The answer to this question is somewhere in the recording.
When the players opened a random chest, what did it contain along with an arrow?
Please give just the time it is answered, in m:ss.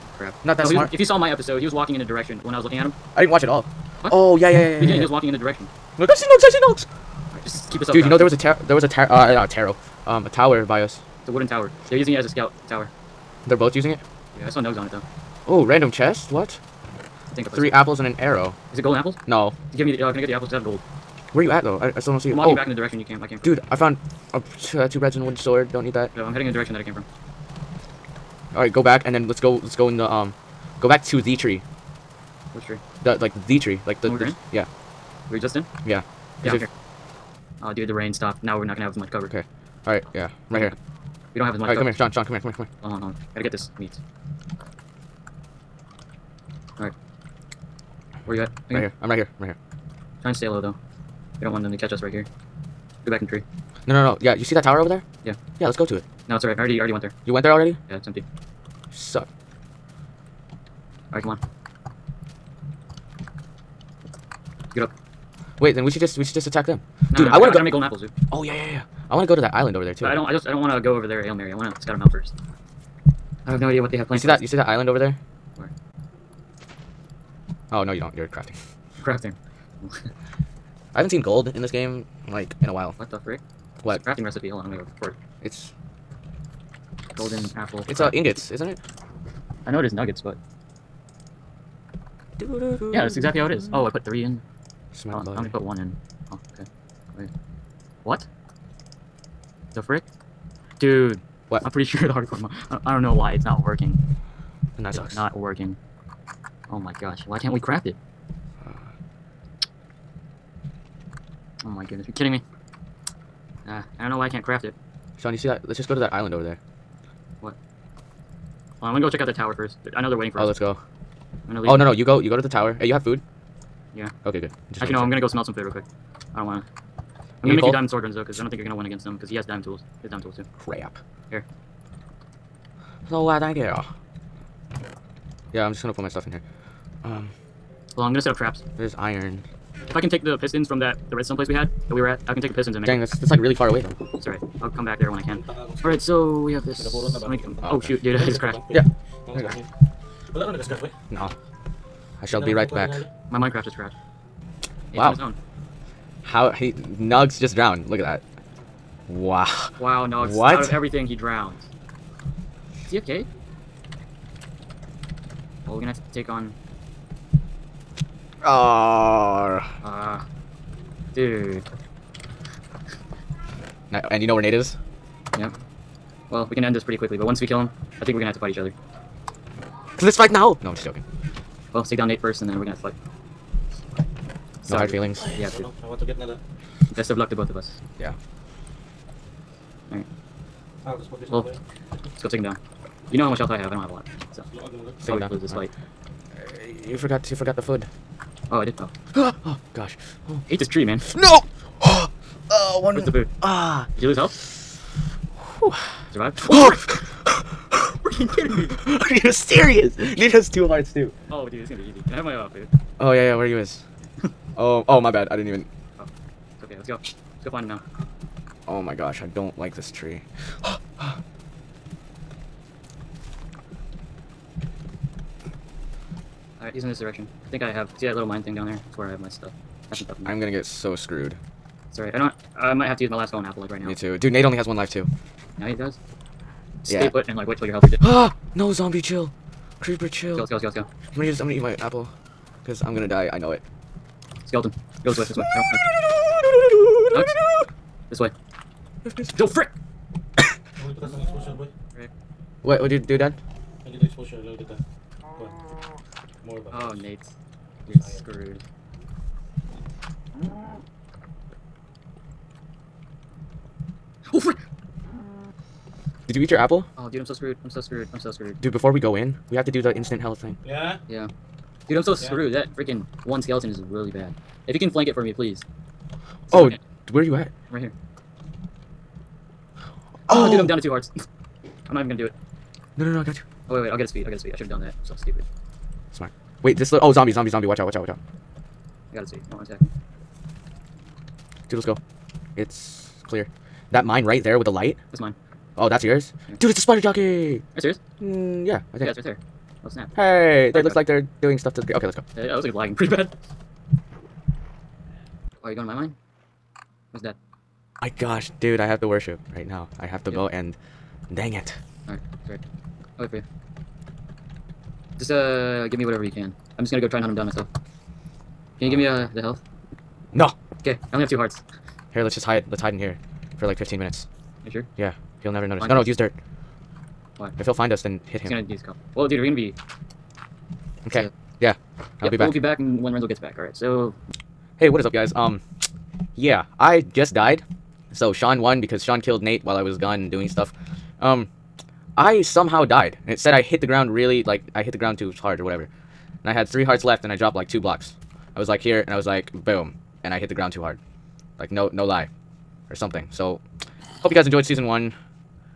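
0:17.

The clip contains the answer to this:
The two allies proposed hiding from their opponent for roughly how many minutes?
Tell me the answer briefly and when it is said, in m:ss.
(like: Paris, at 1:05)
15 minutes, at 5:23.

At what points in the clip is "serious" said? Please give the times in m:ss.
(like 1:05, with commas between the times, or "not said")
3:29, 4:57.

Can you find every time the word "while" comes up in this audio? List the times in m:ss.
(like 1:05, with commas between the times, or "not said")
1:22, 5:39.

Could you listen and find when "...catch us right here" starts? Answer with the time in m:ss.
0:51.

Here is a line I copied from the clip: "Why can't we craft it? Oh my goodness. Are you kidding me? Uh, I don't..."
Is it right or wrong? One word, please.
right.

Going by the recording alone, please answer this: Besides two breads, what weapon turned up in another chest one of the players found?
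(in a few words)
wooden sword.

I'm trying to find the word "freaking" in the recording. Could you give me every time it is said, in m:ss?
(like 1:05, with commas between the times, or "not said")
3:28, 4:32.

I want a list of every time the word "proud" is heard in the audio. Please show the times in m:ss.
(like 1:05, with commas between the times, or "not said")
0:08.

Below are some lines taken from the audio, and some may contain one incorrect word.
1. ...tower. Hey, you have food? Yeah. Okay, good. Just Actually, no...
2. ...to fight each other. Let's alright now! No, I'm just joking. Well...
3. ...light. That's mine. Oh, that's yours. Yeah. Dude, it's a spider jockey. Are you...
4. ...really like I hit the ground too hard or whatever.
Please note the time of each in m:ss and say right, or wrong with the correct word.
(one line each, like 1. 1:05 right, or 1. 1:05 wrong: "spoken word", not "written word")
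1. 2:02 right
2. 2:58 wrong: "fight", not "alright"
3. 4:54 right
4. 5:44 right.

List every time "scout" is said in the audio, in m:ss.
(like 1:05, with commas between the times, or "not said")
0:12, 1:11.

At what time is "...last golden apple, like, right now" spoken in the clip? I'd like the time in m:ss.
3:53.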